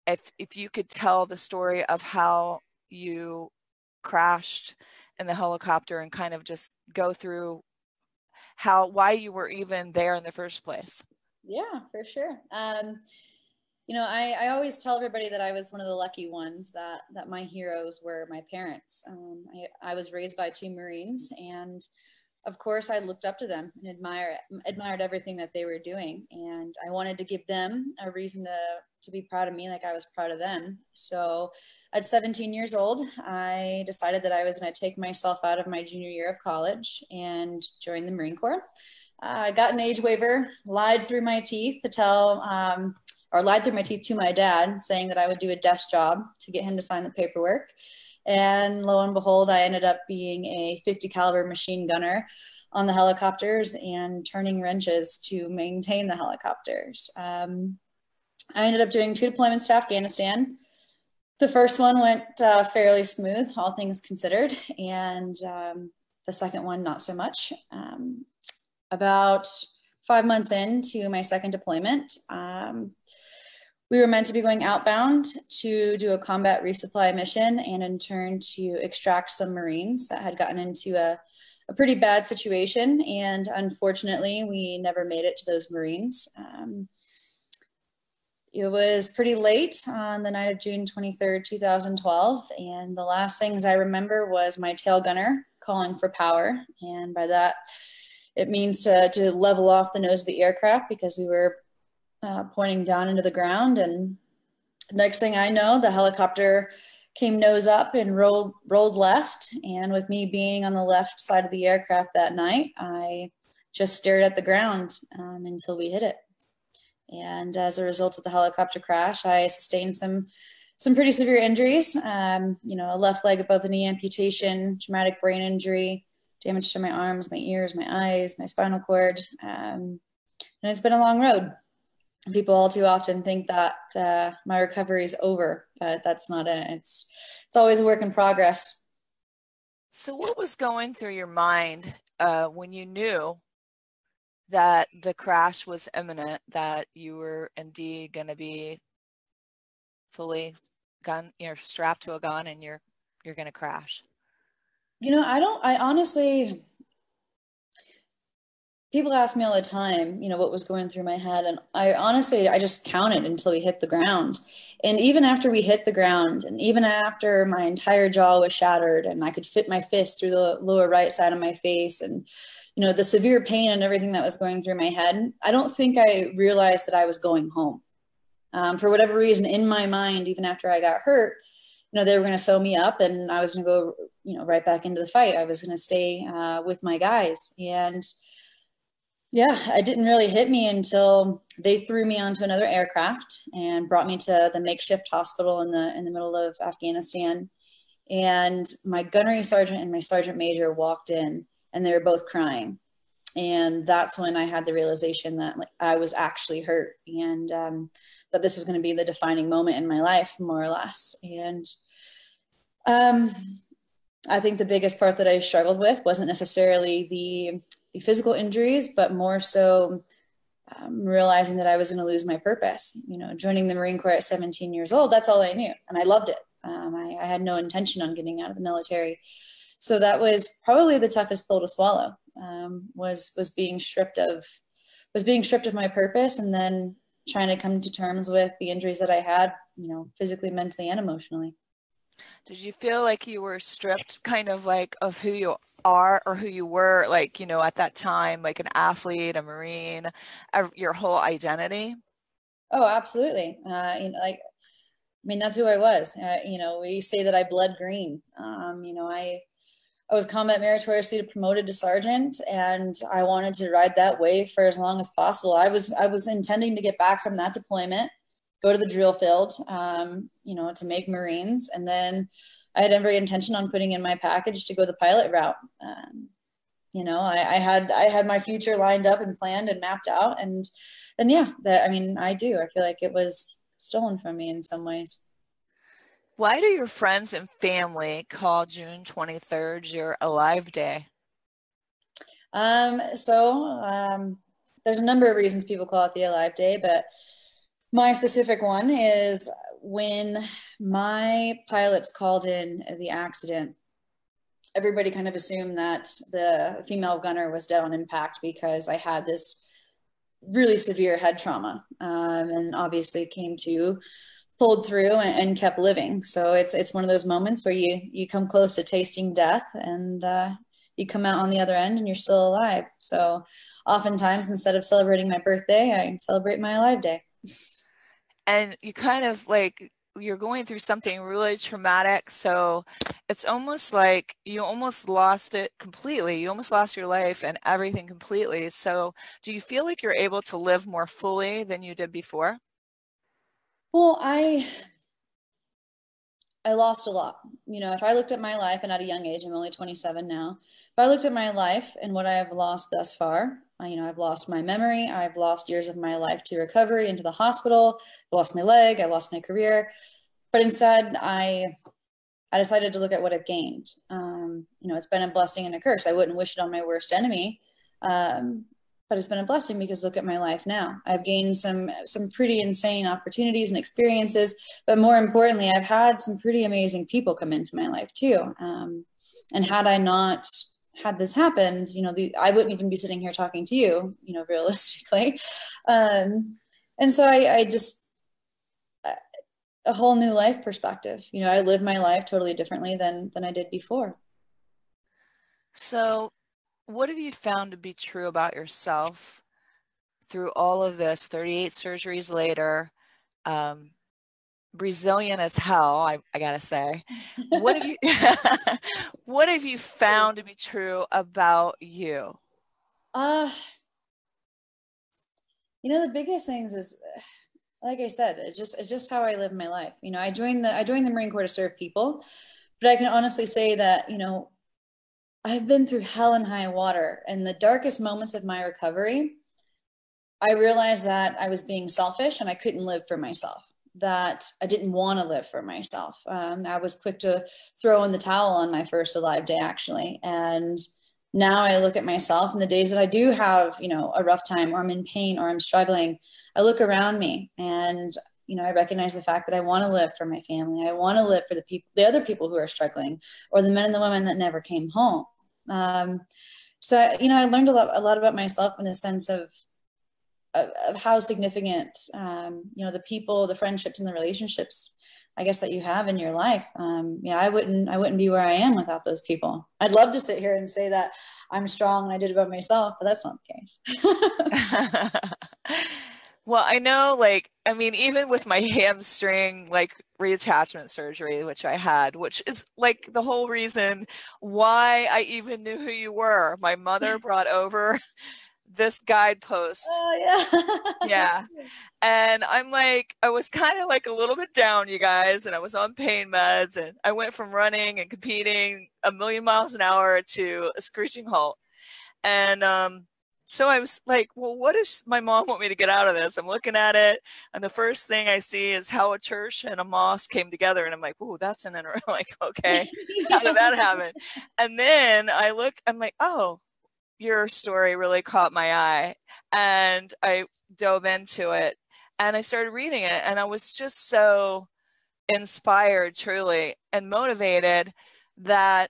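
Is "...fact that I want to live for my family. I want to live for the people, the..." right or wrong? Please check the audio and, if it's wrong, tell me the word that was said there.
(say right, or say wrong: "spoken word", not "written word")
right.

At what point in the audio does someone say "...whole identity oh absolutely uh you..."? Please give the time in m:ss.
4:10.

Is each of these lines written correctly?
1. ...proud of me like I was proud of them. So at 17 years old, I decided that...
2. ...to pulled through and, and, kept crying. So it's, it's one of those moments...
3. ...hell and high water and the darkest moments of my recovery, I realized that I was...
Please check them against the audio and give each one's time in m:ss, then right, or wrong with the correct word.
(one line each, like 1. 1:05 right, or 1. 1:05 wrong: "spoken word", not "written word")
1. 0:29 right
2. 5:13 wrong: "living", not "crying"
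3. 7:06 right.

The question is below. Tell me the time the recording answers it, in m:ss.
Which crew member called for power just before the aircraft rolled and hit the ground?
1:34.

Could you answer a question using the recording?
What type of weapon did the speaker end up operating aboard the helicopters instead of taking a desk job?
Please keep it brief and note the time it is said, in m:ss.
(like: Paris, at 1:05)
50 caliber machine gun, at 0:50.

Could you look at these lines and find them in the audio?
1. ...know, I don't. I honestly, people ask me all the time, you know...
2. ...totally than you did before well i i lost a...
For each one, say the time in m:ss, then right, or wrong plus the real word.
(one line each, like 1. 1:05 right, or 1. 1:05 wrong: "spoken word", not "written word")
1. 2:35 right
2. 5:41 wrong: "fully", not "totally".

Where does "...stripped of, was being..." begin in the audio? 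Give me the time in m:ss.
3:53.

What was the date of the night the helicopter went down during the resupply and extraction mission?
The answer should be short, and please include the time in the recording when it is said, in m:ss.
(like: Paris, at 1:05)
June 23rd, 2012, at 1:30.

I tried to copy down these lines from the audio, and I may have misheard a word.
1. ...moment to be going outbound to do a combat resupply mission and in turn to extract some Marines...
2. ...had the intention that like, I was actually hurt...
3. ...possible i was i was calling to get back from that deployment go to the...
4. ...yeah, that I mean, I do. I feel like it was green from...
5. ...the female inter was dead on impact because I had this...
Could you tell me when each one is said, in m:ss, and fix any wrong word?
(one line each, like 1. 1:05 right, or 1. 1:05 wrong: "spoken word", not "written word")
1. 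1:14 wrong: "meant", not "moment"
2. 3:24 wrong: "realization", not "intention"
3. 4:25 wrong: "intending", not "calling"
4. 4:41 wrong: "stolen", not "green"
5. 5:06 wrong: "gunner", not "inter".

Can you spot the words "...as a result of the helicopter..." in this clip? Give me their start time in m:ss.
1:57.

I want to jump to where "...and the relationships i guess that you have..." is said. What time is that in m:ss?
7:43.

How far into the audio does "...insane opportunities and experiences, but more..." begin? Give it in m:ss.
6:12.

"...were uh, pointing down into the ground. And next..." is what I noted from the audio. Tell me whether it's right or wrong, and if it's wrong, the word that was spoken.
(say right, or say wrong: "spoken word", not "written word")
right.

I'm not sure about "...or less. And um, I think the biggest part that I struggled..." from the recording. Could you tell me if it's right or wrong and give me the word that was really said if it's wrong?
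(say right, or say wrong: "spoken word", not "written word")
right.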